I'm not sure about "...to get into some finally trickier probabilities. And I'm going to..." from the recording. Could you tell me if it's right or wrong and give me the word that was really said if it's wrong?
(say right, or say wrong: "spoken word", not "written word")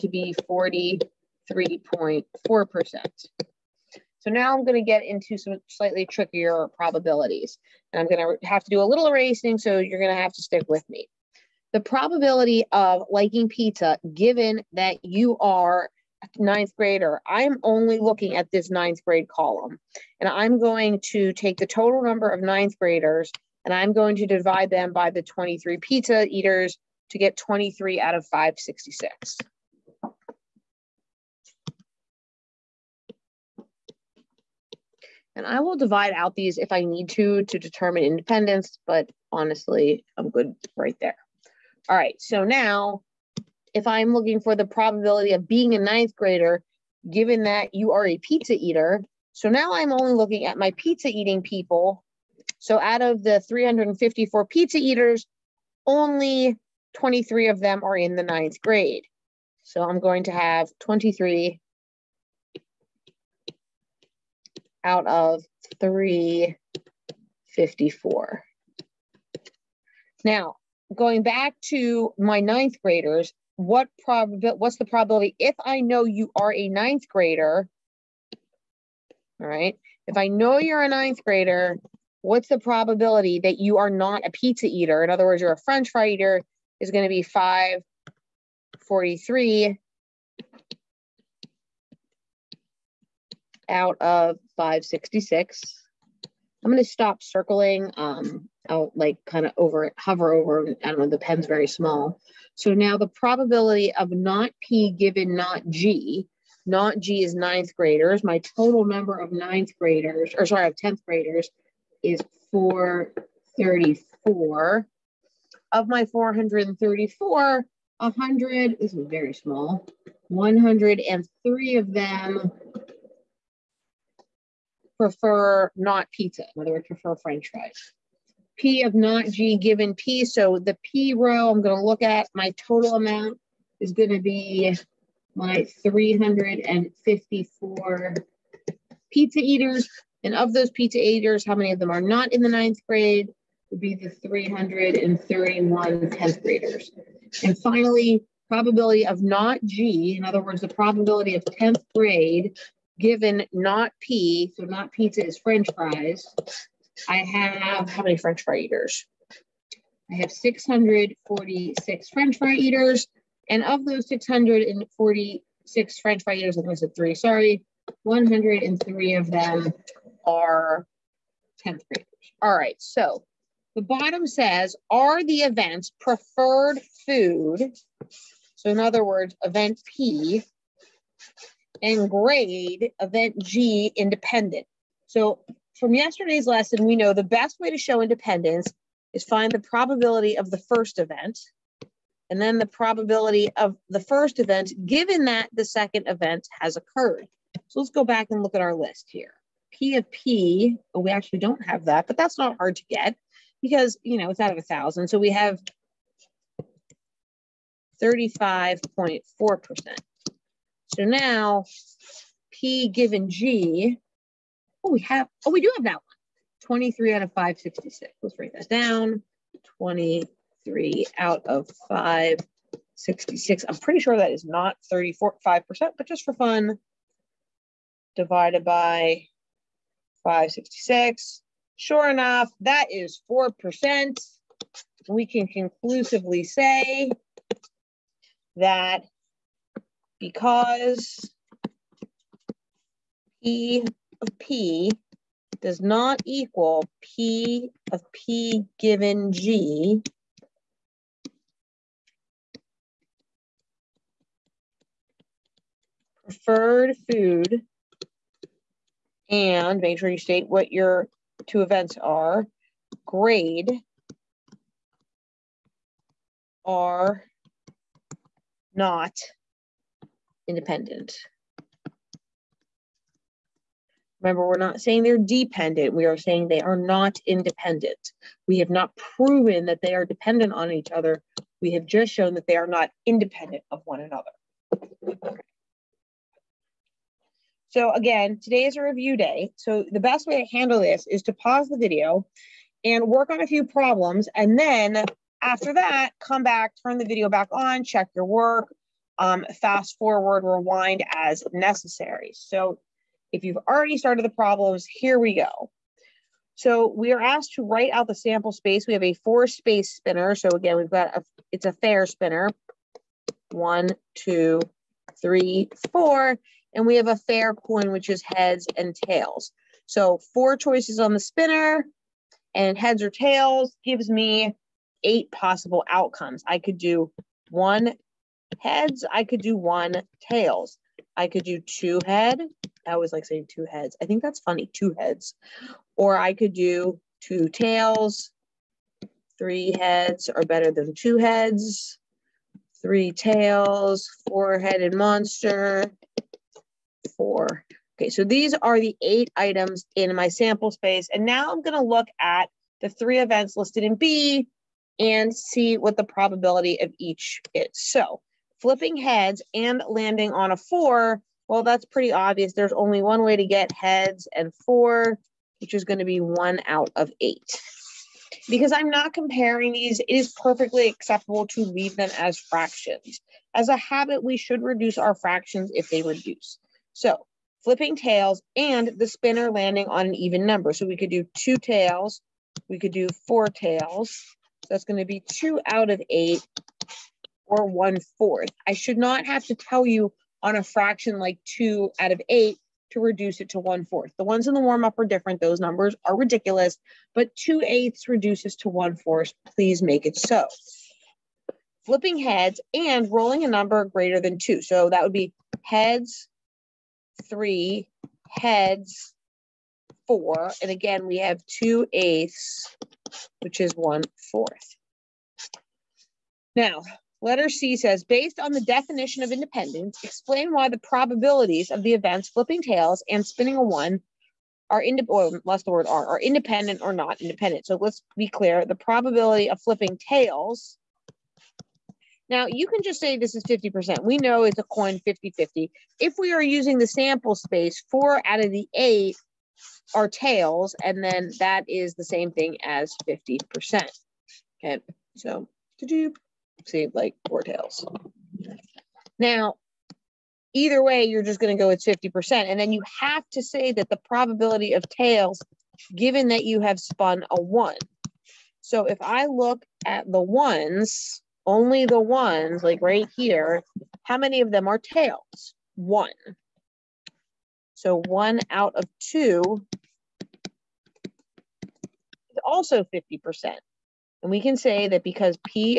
wrong: "slightly", not "finally".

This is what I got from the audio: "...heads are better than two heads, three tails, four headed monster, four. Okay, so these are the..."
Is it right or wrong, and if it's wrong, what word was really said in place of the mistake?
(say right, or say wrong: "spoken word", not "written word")
right.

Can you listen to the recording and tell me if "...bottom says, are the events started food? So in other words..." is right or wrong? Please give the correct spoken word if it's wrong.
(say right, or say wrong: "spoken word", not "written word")
wrong: "preferred", not "started".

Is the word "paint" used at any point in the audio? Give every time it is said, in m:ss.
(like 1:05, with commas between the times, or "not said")
not said.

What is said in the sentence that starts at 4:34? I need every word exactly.
Remember, we're not saying they're dependent.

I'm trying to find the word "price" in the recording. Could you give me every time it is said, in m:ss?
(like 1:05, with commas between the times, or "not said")
not said.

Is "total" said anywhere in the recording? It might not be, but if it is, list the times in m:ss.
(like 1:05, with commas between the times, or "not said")
0:21, 1:48, 2:12.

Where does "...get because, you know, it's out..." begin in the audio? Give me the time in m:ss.
3:22.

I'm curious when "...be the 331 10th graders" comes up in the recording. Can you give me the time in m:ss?
2:23.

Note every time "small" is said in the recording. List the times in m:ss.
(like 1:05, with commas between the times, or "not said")
1:41, 1:59.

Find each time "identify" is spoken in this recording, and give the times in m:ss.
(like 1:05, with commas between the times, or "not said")
not said.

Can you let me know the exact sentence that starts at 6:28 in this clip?
I should not have to tell you on a fraction like two out of eight to reduce it to one fourth.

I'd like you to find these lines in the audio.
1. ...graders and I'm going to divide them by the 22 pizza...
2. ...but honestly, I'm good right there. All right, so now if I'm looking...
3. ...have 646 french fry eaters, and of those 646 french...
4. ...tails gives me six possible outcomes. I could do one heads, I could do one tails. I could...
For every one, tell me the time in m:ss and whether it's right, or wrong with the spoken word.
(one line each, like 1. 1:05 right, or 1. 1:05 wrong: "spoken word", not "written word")
1. 0:22 wrong: "23", not "22"
2. 0:38 right
3. 2:40 right
4. 5:23 wrong: "eight", not "six".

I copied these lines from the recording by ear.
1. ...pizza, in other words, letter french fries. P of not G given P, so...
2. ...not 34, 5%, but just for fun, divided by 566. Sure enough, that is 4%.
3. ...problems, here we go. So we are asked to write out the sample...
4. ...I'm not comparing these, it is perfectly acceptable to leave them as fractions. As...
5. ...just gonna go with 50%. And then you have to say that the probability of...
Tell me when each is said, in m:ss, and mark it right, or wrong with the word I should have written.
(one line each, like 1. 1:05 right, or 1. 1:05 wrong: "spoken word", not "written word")
1. 2:06 wrong: "prefer", not "letter"
2. 3:44 right
3. 5:04 right
4. 6:08 right
5. 7:31 right.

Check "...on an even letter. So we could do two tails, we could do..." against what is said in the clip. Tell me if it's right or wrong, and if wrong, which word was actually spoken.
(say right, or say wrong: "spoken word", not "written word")
wrong: "number", not "letter".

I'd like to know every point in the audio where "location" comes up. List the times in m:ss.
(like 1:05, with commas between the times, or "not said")
not said.